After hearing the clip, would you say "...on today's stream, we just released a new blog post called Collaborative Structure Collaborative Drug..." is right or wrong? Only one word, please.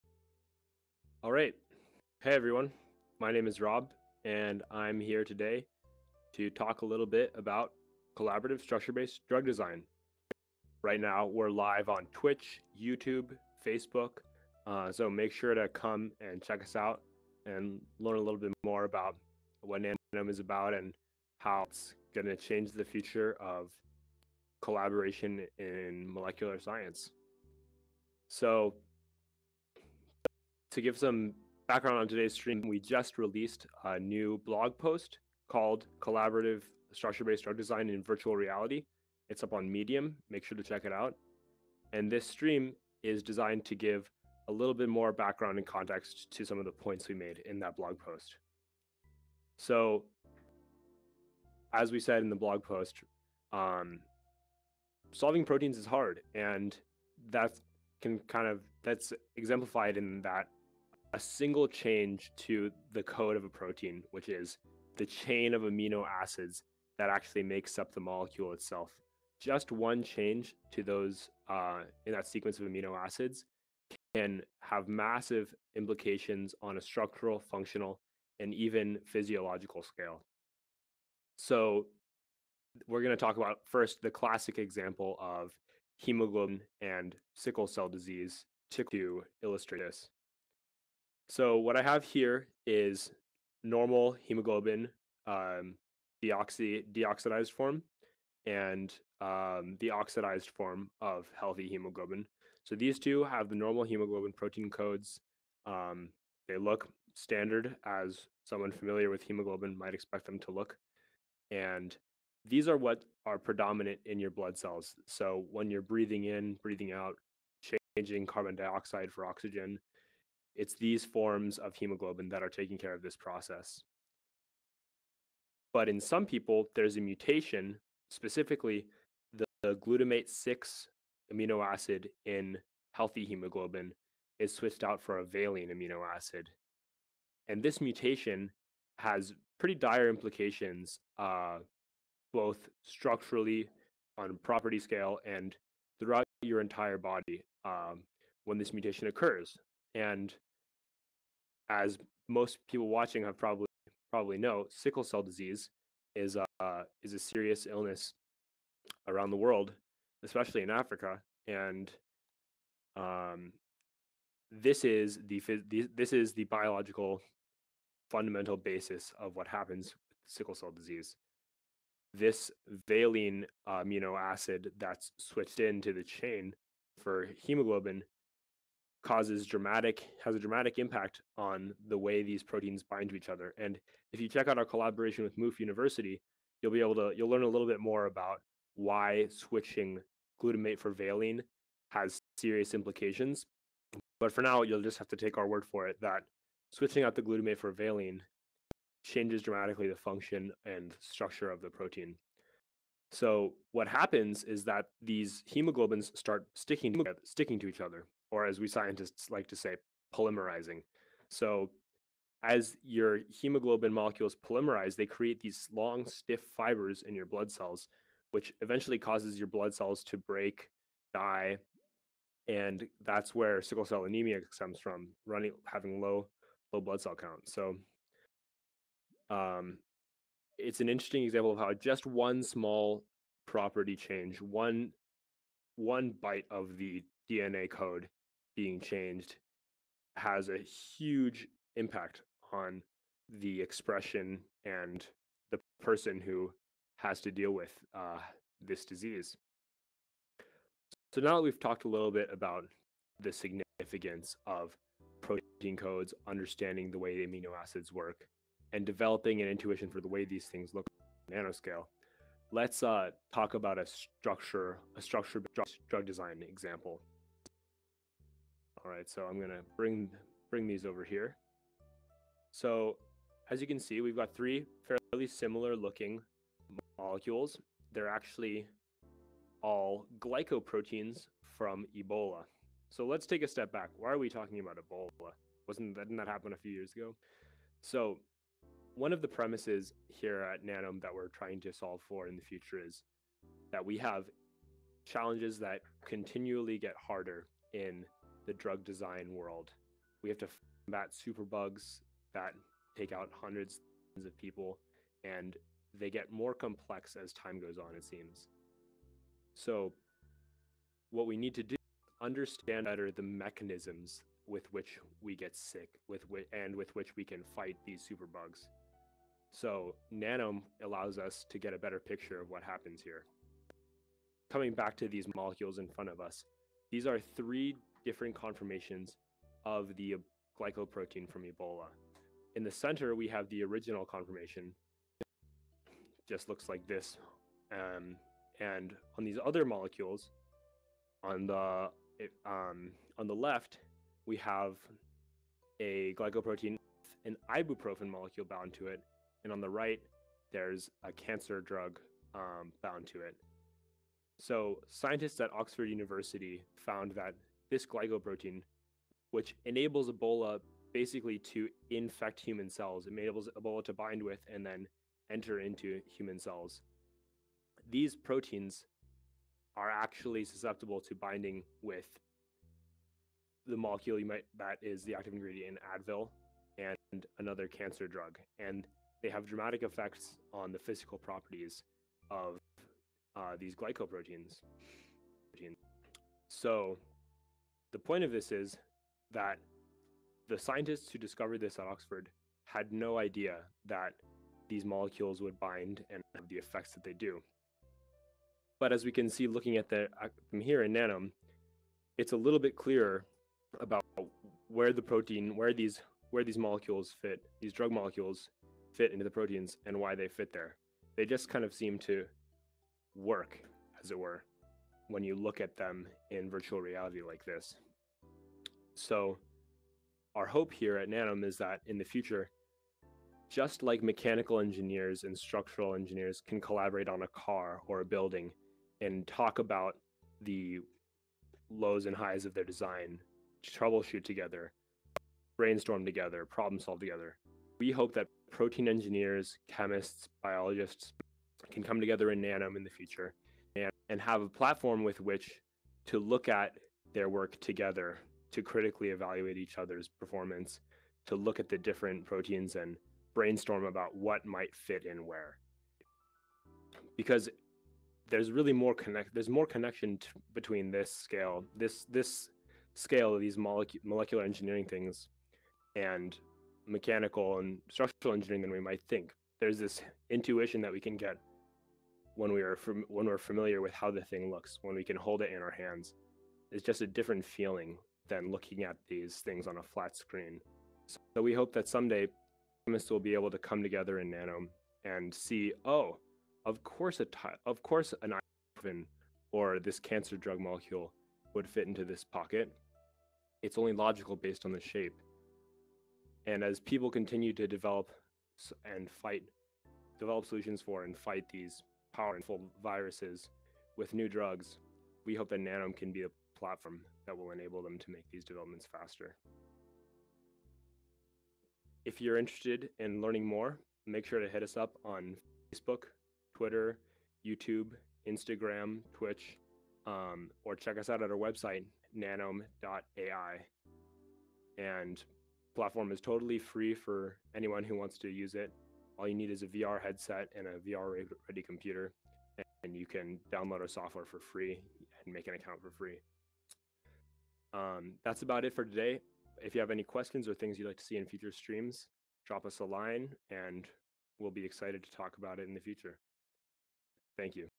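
wrong.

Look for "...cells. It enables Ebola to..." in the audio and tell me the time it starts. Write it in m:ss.
6:02.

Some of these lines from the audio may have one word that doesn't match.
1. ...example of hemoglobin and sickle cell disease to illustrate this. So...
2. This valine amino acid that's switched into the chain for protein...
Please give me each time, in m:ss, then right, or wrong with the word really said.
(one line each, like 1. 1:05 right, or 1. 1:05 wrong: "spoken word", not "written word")
1. 1:24 right
2. 2:52 wrong: "hemoglobin", not "protein".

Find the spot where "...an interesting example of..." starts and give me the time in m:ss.
3:50.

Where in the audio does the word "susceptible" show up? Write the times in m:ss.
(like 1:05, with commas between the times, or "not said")
6:10.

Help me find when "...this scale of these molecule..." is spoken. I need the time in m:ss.
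7:42.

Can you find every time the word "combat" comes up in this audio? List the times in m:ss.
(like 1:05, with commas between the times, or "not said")
5:00.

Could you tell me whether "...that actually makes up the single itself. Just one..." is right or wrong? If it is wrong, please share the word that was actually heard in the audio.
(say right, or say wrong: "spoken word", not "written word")
wrong: "molecule", not "single".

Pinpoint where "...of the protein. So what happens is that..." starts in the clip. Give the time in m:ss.
3:21.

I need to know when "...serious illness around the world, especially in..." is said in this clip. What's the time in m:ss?
2:37.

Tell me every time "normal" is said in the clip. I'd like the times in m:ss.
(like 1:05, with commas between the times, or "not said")
1:33, 1:43.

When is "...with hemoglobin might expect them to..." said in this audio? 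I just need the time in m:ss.
1:49.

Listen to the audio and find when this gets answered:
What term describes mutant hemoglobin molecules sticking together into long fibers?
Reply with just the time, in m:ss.
3:30.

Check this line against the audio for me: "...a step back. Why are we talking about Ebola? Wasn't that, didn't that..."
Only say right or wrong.
right.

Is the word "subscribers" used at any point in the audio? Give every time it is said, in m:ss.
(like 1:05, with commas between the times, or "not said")
not said.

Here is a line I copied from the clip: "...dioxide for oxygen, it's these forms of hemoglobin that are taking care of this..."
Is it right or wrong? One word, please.
right.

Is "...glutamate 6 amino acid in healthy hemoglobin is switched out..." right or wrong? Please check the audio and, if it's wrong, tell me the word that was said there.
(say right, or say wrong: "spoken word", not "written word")
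right.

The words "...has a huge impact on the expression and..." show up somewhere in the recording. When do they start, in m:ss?
4:00.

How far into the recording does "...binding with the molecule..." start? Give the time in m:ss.
6:11.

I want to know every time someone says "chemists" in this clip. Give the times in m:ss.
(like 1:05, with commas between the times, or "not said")
7:19, 8:02.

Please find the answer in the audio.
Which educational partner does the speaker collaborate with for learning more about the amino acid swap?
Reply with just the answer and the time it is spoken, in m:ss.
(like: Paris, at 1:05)
MOOF University, at 3:05.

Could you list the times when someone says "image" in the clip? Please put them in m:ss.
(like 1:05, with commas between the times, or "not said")
not said.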